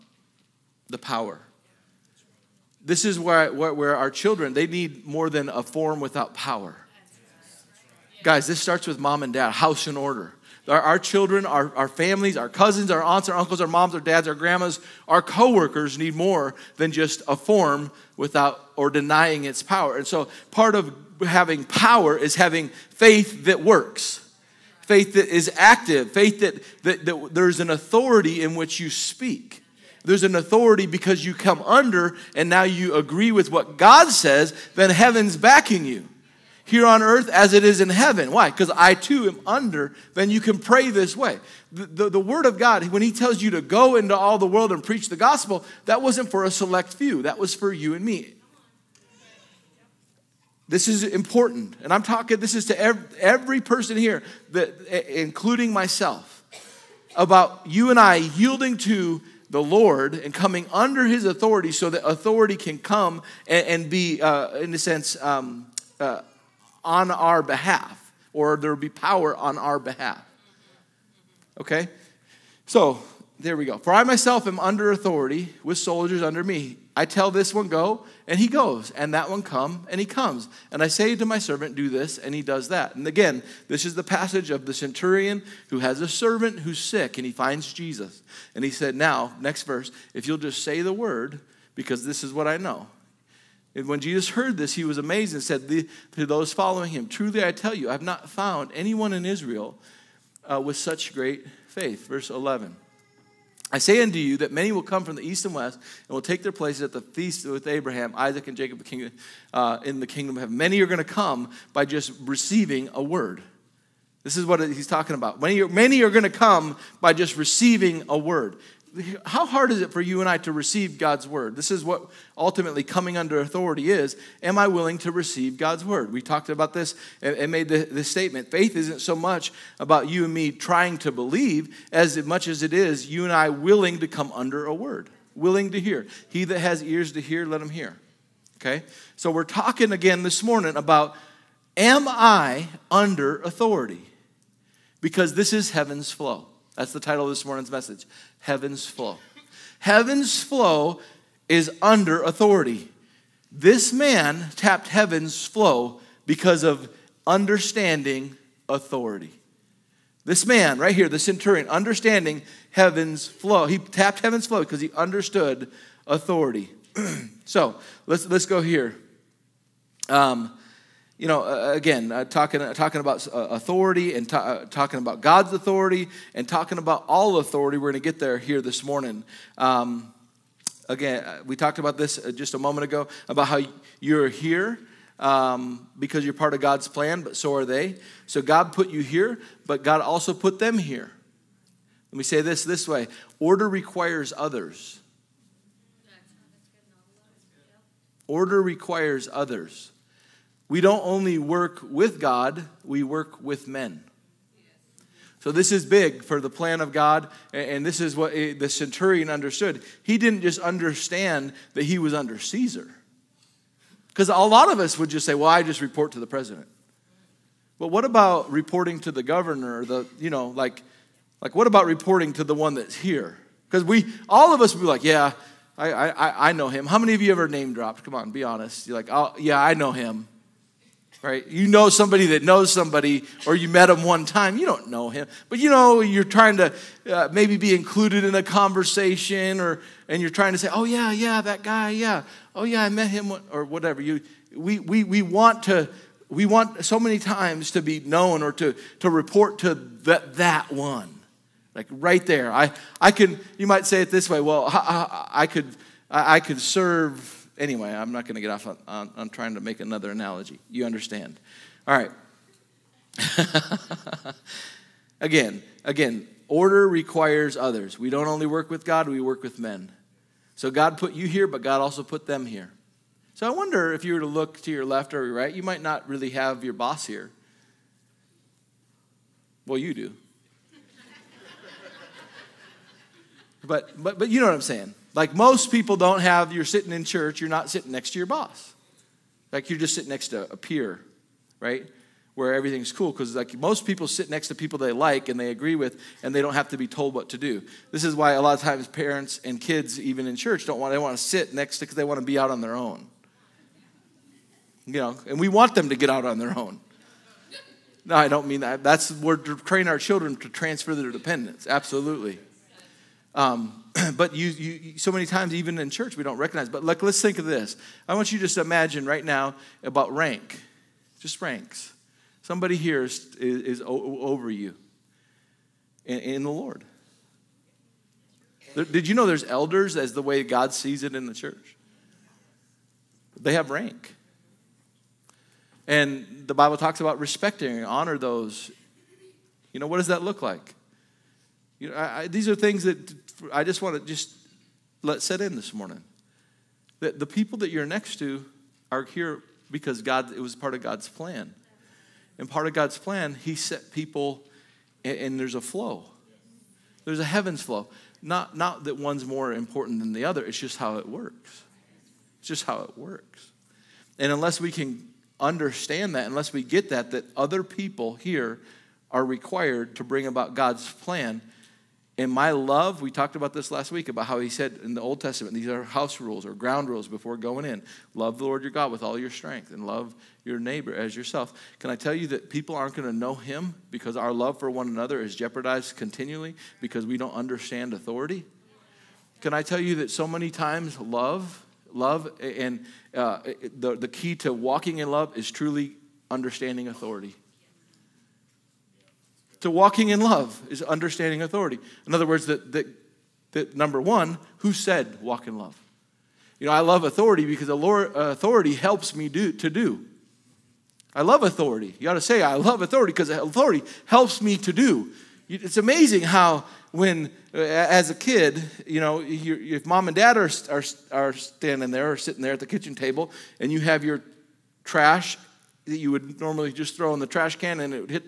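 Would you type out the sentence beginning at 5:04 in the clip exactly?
You know, and we want them to get out on their own.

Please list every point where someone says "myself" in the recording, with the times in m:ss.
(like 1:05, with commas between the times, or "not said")
0:55, 1:14.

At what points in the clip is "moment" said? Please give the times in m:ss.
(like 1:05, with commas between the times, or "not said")
3:02.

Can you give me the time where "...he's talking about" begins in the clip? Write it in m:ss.
1:54.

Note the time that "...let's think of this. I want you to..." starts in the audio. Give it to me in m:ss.
5:17.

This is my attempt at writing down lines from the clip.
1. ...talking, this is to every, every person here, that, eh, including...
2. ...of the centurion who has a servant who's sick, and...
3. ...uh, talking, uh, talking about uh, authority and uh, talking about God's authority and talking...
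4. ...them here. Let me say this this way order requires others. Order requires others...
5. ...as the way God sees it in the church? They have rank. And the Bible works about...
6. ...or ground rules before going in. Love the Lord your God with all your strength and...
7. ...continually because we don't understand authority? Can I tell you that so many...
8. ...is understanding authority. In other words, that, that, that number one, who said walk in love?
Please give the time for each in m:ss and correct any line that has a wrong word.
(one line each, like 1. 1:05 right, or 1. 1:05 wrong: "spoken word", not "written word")
1. 0:52 right
2. 1:24 right
3. 2:52 right
4. 3:10 right
5. 5:29 wrong: "talks", not "works"
6. 6:16 right
7. 6:25 right
8. 6:40 right.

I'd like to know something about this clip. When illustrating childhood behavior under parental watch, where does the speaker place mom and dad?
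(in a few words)
Kitchen table.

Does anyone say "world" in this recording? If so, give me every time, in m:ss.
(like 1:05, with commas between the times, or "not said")
0:44.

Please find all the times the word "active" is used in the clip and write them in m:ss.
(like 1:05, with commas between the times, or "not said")
0:25.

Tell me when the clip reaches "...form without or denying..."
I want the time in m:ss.
0:17.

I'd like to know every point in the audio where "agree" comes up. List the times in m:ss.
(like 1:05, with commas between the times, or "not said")
0:32, 4:55.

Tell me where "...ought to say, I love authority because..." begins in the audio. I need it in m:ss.
6:52.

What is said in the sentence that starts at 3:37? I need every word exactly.
But what about reporting to the governor, the, you know, like, like what about reporting to the one that's here?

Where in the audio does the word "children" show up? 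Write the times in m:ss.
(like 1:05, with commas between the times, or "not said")
0:04, 0:10, 5:09.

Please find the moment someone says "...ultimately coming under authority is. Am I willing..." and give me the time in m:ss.
2:02.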